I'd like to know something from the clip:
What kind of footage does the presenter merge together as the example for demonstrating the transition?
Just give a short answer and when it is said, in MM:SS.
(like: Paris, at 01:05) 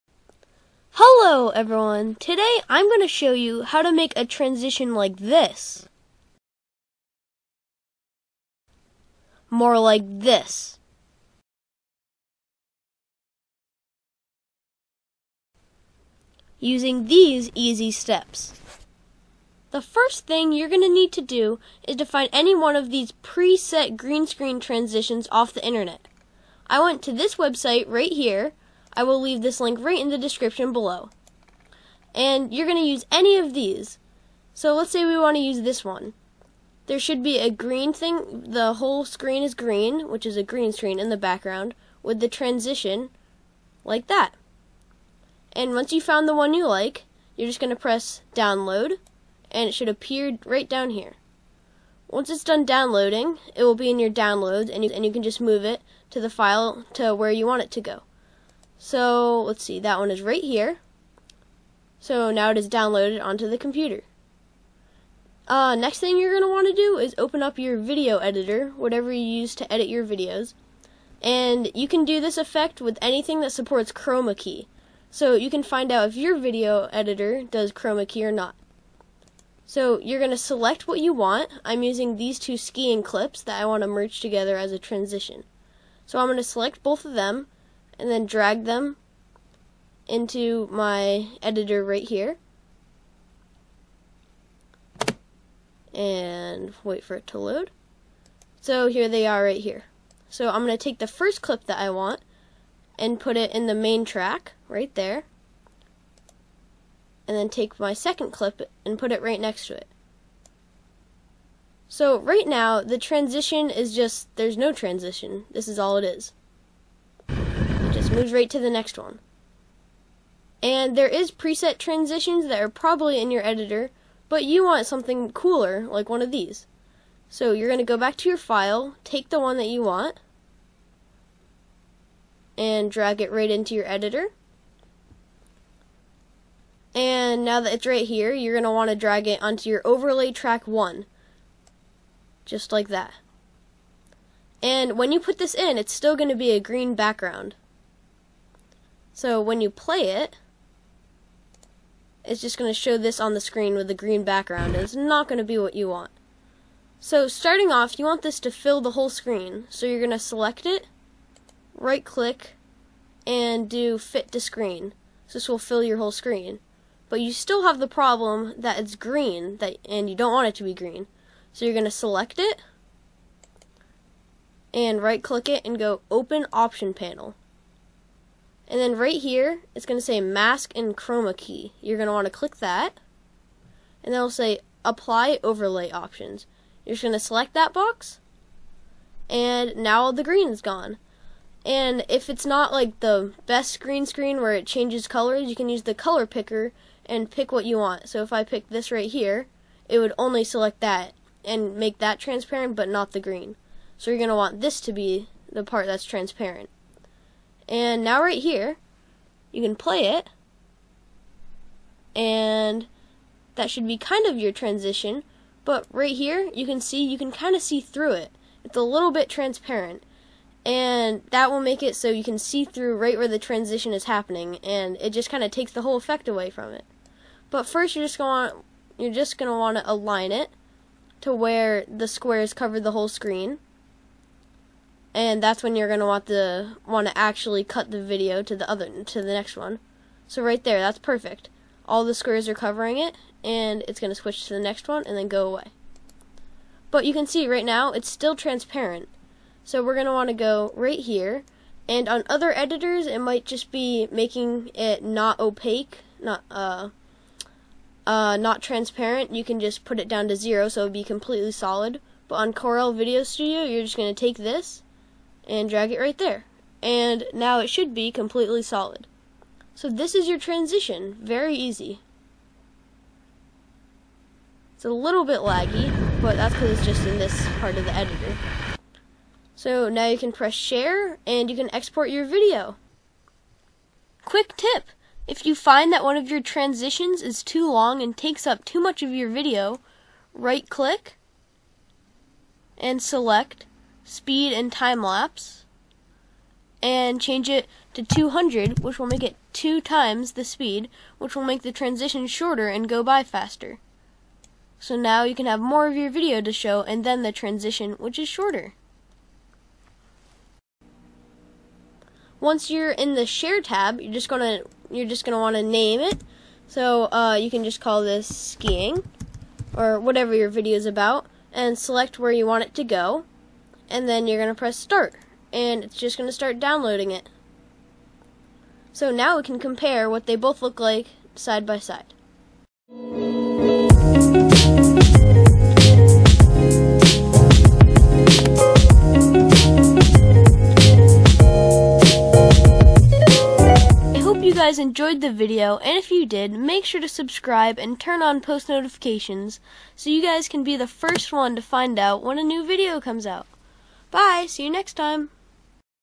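skiing clips, at 01:22.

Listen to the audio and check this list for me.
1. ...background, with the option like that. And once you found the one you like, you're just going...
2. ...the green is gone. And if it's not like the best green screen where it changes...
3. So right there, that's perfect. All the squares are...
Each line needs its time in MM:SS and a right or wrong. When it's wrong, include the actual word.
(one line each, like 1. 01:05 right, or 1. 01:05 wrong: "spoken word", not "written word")
1. 00:41 wrong: "transition", not "option"
2. 03:10 right
3. 04:00 right.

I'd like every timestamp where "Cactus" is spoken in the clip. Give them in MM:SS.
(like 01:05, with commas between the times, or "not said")
not said.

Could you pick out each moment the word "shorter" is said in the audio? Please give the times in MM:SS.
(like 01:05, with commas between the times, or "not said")
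05:02, 05:08.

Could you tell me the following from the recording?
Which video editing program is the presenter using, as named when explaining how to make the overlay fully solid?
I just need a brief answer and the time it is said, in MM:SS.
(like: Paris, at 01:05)
Corel Video Studio, at 04:22.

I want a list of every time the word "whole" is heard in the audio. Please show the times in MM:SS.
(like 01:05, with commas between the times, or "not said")
00:38, 02:38, 02:45, 03:45, 03:52.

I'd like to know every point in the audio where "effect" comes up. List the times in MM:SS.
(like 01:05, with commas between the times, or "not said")
01:12, 03:45.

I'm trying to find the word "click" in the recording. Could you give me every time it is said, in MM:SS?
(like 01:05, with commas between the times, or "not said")
02:42, 02:55, 03:02, 04:50.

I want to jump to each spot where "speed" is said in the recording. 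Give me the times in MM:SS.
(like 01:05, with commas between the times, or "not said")
04:54, 05:00.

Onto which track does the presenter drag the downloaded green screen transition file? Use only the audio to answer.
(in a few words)
overlay track 1.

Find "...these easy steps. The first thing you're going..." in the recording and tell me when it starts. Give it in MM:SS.
00:17.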